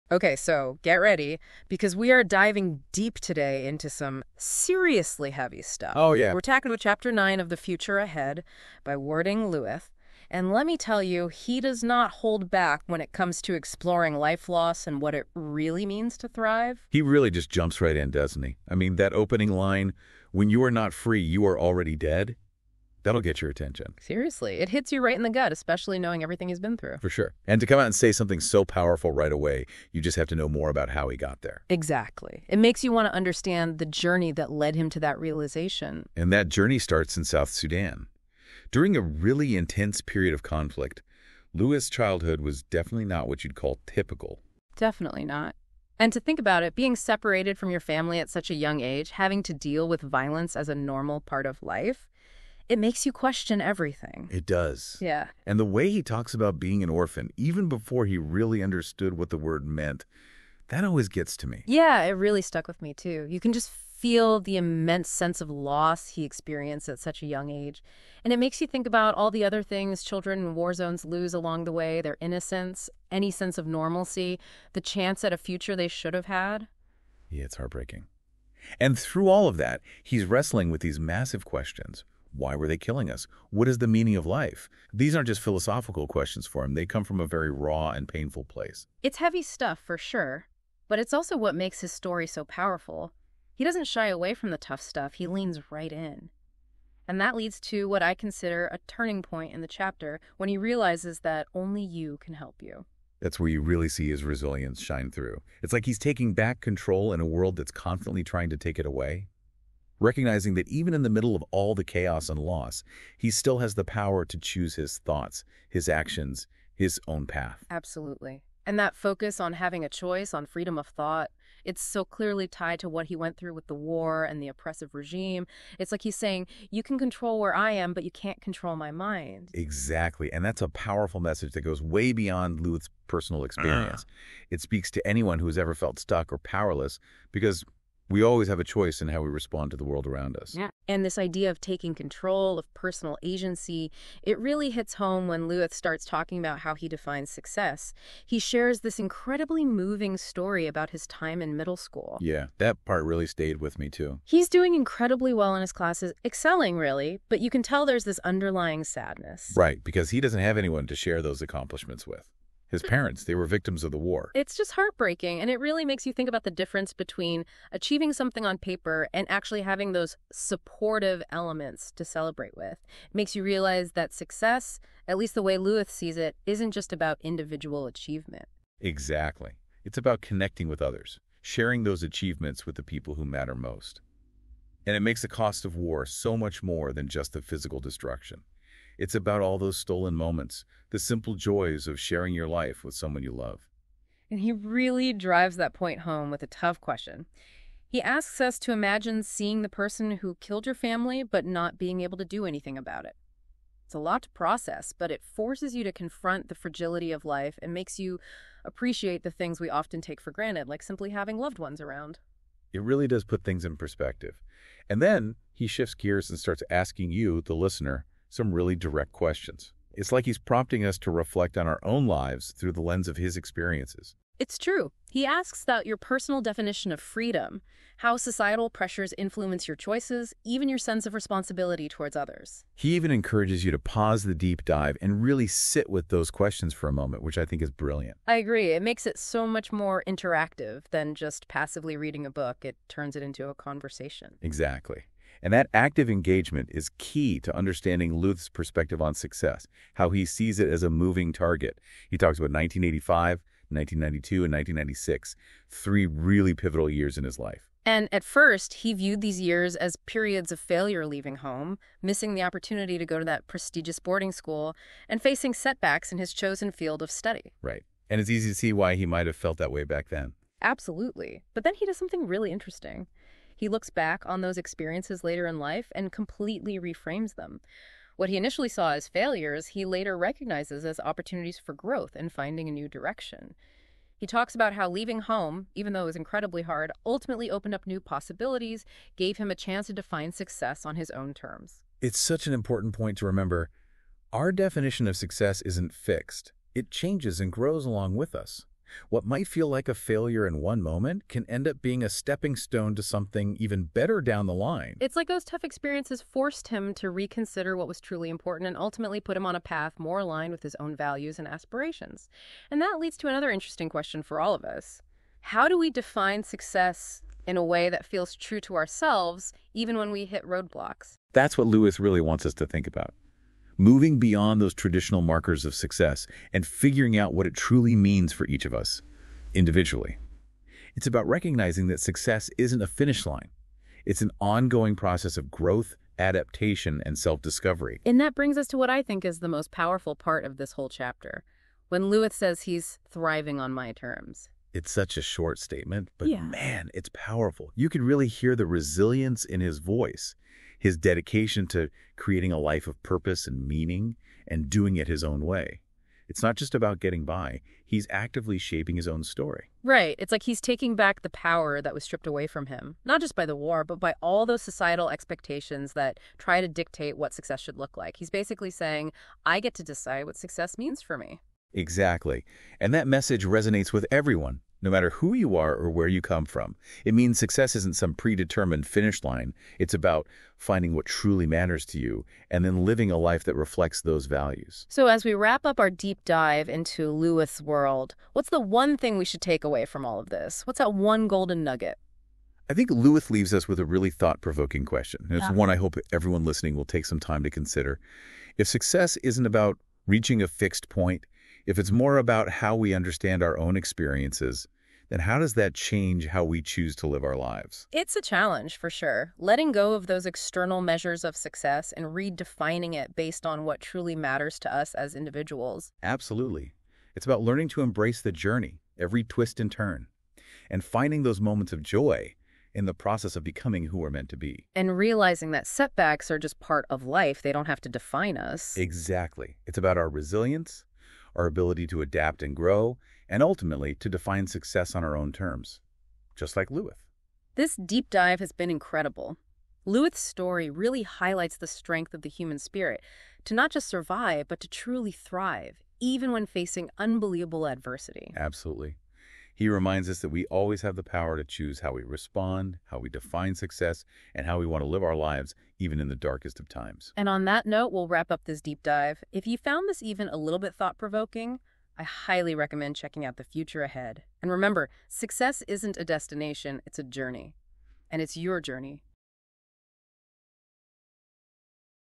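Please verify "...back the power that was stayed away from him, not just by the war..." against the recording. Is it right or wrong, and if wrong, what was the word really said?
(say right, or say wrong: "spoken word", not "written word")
wrong: "stripped", not "stayed".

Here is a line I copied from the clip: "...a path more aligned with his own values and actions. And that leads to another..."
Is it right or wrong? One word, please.
wrong.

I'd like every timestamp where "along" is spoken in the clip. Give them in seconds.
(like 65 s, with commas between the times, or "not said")
71 s, 297 s.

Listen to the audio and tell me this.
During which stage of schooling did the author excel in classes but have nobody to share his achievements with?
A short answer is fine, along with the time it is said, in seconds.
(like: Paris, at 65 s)
middle school, at 151 s.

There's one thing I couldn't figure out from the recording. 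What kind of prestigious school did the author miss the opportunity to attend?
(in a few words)
boarding school.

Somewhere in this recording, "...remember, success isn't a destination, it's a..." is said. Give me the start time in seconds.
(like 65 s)
464 s.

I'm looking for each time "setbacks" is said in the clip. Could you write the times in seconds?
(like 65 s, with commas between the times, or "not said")
265 s, 425 s.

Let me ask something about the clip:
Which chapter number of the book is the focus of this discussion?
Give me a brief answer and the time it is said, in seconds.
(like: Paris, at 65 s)
9, at 6 s.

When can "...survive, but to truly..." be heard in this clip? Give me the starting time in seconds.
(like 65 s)
443 s.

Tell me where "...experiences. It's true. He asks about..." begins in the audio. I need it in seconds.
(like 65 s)
223 s.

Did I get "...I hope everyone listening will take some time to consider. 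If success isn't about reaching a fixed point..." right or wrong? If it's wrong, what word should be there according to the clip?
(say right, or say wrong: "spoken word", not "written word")
right.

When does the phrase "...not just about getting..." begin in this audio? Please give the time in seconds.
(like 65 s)
356 s.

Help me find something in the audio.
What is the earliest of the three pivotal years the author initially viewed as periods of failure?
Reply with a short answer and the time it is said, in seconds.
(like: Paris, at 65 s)
1985, at 252 s.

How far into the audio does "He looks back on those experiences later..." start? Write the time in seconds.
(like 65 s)
273 s.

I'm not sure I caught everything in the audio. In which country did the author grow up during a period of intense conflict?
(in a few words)
South Sudan.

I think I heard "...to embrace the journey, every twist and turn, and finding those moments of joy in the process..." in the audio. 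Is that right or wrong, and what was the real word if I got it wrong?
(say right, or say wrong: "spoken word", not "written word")
right.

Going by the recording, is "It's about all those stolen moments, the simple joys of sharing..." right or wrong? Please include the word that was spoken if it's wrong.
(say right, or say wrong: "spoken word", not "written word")
right.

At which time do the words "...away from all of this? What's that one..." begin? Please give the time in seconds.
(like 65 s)
389 s.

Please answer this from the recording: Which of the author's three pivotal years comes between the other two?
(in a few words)
1992.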